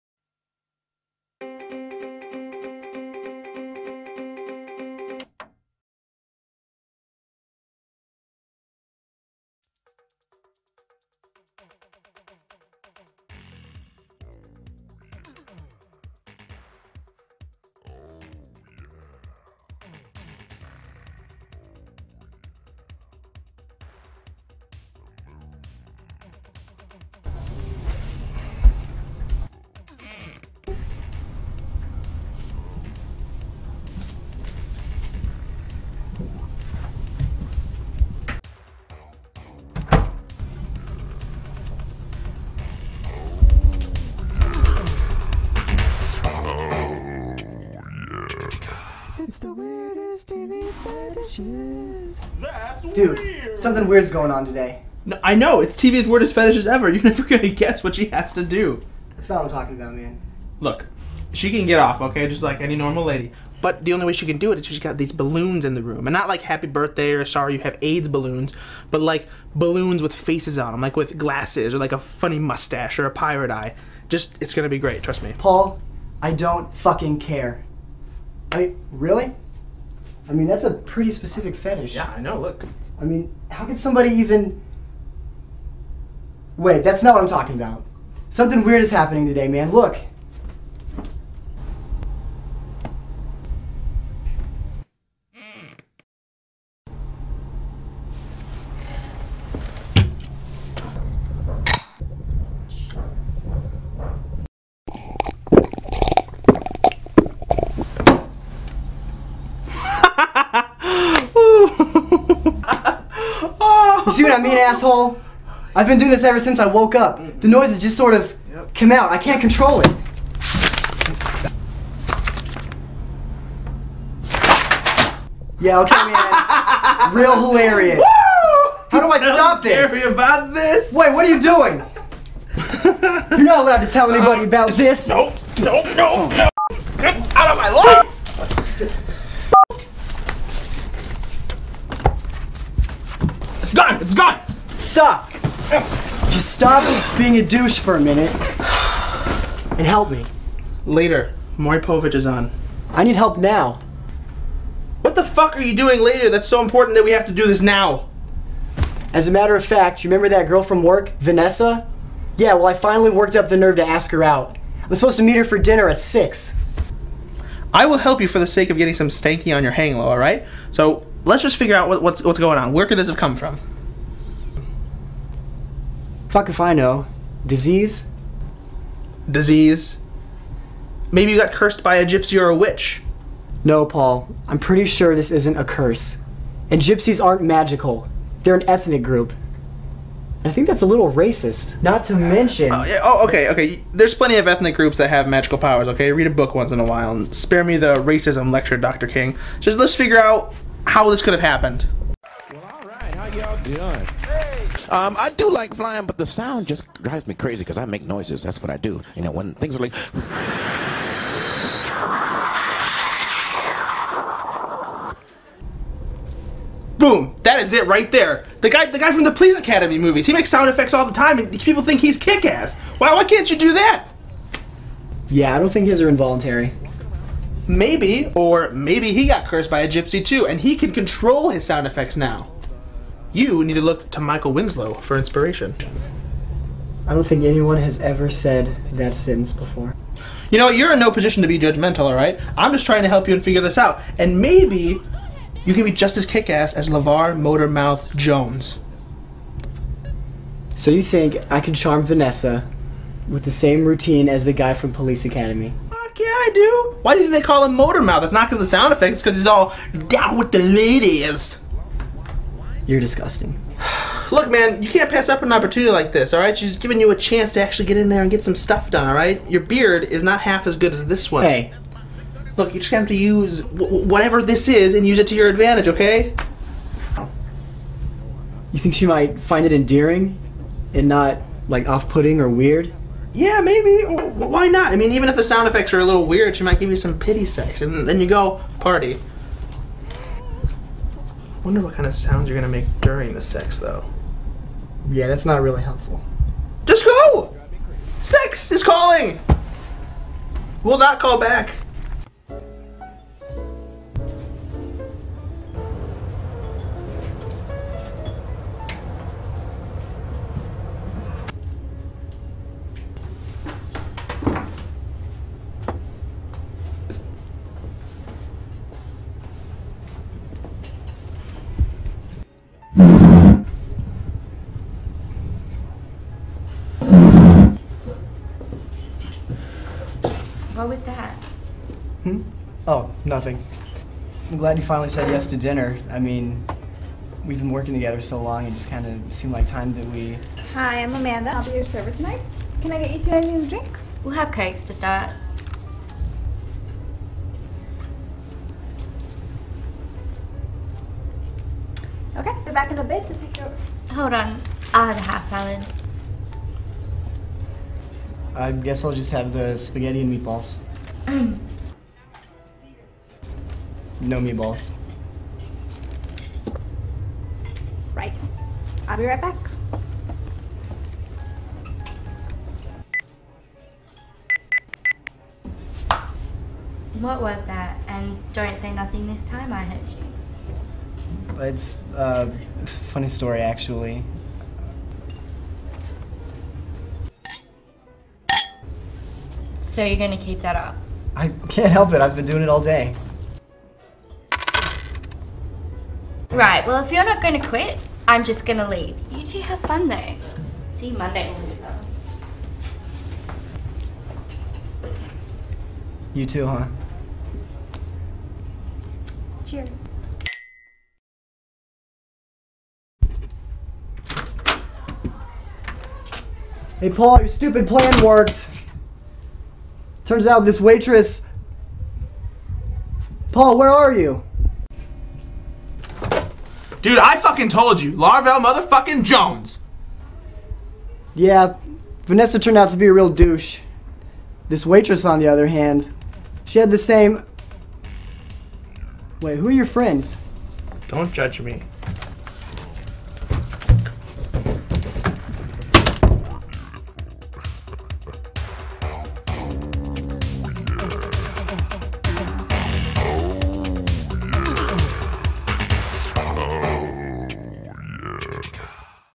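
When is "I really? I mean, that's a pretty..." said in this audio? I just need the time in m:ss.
1:18.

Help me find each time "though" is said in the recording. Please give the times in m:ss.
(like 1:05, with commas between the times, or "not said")
4:53, 6:40.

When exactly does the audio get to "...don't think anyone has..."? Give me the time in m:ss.
3:57.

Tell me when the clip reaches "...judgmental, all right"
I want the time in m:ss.
4:01.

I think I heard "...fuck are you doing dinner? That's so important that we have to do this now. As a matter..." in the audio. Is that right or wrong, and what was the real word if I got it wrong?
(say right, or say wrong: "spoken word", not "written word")
wrong: "later", not "dinner".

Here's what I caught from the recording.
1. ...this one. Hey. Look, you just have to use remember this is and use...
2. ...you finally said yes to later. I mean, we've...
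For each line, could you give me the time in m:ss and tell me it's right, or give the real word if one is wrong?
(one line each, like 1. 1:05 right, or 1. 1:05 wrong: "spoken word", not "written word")
1. 4:31 wrong: "whatever", not "remember"
2. 5:34 wrong: "dinner", not "later".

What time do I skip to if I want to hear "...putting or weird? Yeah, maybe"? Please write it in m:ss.
4:42.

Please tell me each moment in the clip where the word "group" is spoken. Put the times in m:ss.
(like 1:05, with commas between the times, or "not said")
3:09, 3:14.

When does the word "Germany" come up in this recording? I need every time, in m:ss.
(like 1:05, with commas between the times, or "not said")
not said.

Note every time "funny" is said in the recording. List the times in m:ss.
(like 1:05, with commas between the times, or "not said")
1:11, 6:22.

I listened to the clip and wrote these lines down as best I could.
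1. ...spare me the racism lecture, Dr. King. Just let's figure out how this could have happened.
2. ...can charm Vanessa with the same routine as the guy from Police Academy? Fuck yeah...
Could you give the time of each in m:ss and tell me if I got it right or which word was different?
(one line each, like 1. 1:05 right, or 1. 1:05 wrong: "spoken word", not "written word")
1. 3:17 right
2. 4:11 right.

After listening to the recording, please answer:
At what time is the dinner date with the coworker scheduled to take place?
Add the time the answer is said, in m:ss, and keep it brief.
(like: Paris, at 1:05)
6, at 2:45.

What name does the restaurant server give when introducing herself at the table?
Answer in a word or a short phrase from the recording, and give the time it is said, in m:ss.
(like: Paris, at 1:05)
Amanda, at 5:41.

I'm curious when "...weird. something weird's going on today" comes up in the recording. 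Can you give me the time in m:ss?
0:53.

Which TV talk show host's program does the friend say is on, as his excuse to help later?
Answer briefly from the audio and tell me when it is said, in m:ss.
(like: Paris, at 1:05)
Povich, at 2:31.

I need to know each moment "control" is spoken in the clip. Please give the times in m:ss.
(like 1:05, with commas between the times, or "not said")
1:59, 3:50.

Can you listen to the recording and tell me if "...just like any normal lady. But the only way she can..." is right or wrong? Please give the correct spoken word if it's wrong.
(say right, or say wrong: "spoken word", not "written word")
right.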